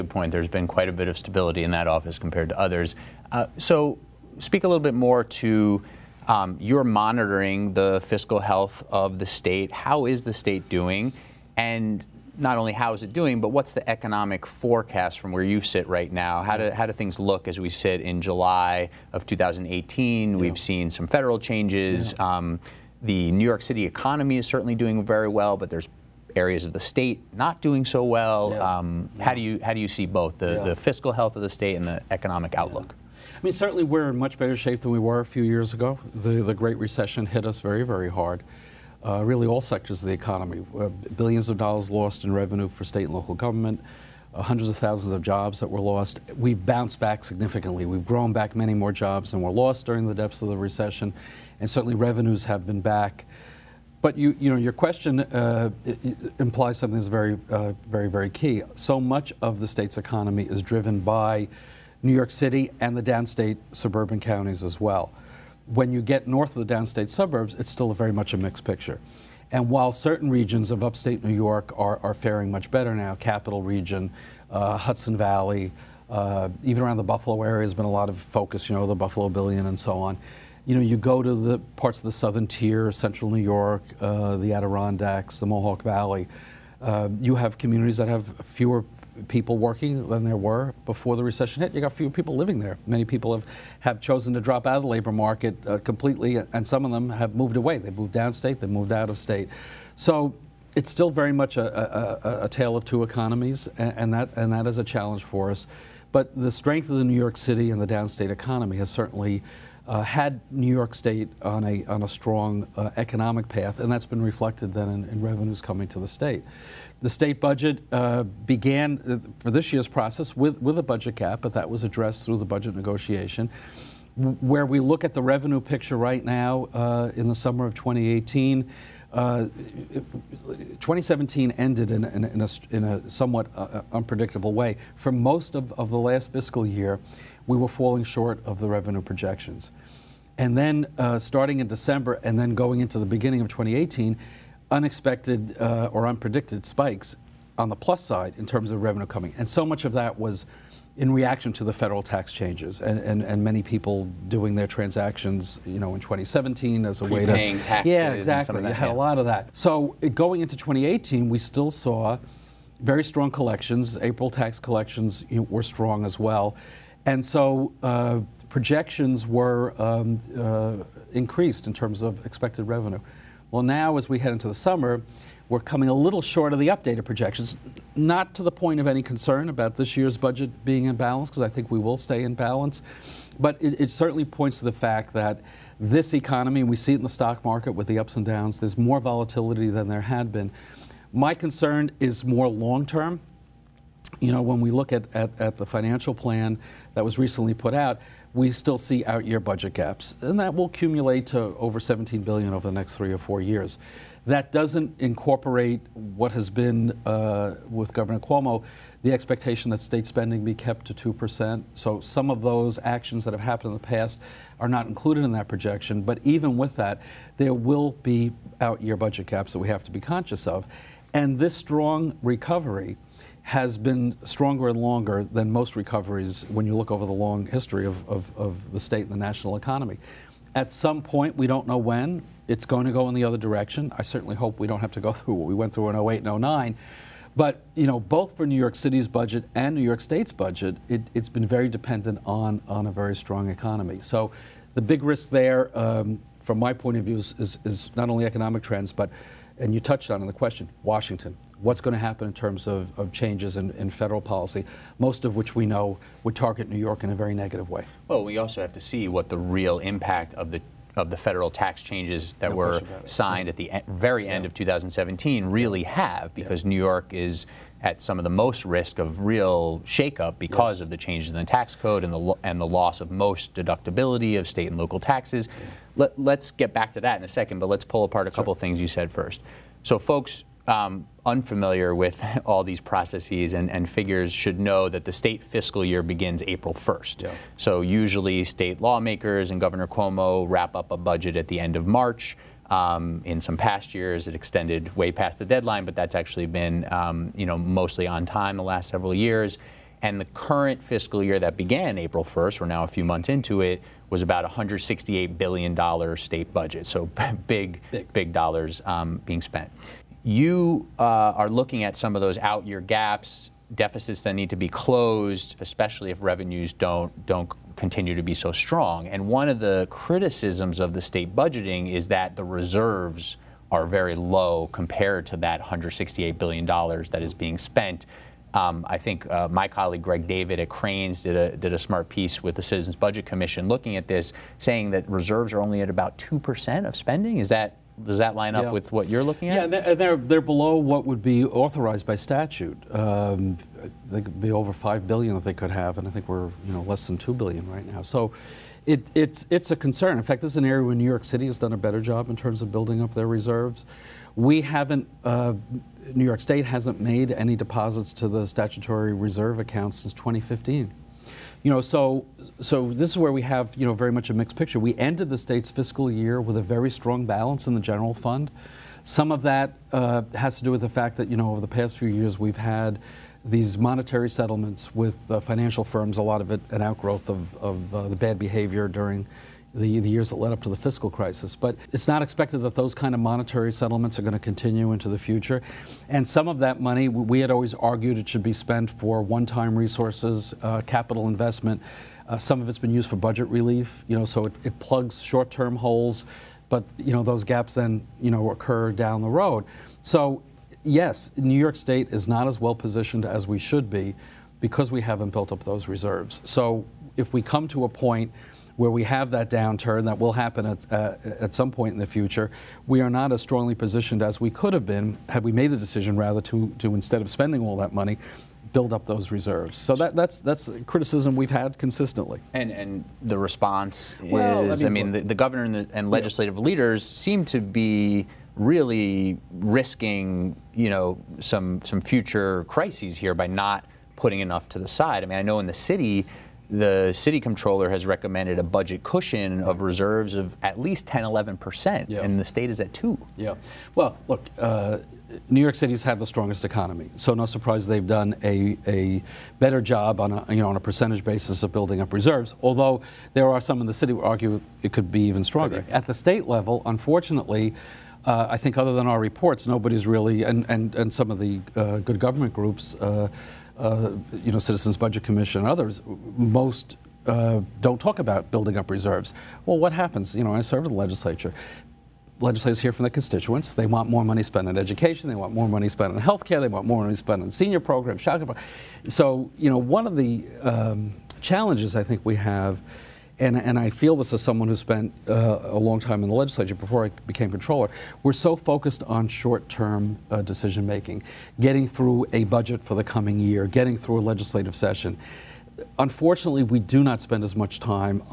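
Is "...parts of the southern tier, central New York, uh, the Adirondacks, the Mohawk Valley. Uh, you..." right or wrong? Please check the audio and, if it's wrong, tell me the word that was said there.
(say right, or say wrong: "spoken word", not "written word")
right.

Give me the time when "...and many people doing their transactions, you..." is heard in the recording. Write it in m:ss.
2:33.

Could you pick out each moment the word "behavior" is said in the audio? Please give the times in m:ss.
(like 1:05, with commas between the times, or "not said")
6:18.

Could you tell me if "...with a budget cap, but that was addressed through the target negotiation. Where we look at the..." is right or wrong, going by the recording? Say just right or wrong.
wrong.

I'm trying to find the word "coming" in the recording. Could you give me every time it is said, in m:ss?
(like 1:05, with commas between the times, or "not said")
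1:55, 2:29, 2:55, 8:13.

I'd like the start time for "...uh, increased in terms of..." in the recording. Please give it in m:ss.
2:50.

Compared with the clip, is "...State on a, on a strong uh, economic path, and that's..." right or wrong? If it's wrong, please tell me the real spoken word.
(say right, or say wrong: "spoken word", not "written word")
right.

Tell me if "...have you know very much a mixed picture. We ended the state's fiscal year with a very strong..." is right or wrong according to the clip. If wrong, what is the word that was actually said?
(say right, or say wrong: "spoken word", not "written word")
right.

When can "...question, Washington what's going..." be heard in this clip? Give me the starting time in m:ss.
4:10.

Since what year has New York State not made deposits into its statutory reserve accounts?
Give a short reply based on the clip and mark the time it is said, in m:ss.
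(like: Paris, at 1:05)
2015, at 6:00.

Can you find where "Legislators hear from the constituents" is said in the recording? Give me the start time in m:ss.
7:52.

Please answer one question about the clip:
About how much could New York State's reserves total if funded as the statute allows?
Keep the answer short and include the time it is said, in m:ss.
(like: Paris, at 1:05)
Over 5 billion, at 5:44.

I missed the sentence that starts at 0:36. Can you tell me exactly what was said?
The the Great Recession hit us very very hard.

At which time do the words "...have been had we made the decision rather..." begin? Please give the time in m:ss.
6:54.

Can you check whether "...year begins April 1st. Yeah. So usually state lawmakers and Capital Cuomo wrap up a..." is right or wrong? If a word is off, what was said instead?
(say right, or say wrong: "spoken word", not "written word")
wrong: "Governor", not "Capital".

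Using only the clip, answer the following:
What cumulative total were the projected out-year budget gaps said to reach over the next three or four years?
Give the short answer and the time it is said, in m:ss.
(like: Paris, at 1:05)
Over 17 billion, at 3:21.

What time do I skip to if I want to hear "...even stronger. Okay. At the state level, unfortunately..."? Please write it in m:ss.
7:35.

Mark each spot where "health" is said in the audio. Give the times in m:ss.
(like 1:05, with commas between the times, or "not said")
0:08, 0:31, 7:56.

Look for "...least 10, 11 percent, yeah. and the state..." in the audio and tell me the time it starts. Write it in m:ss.
7:20.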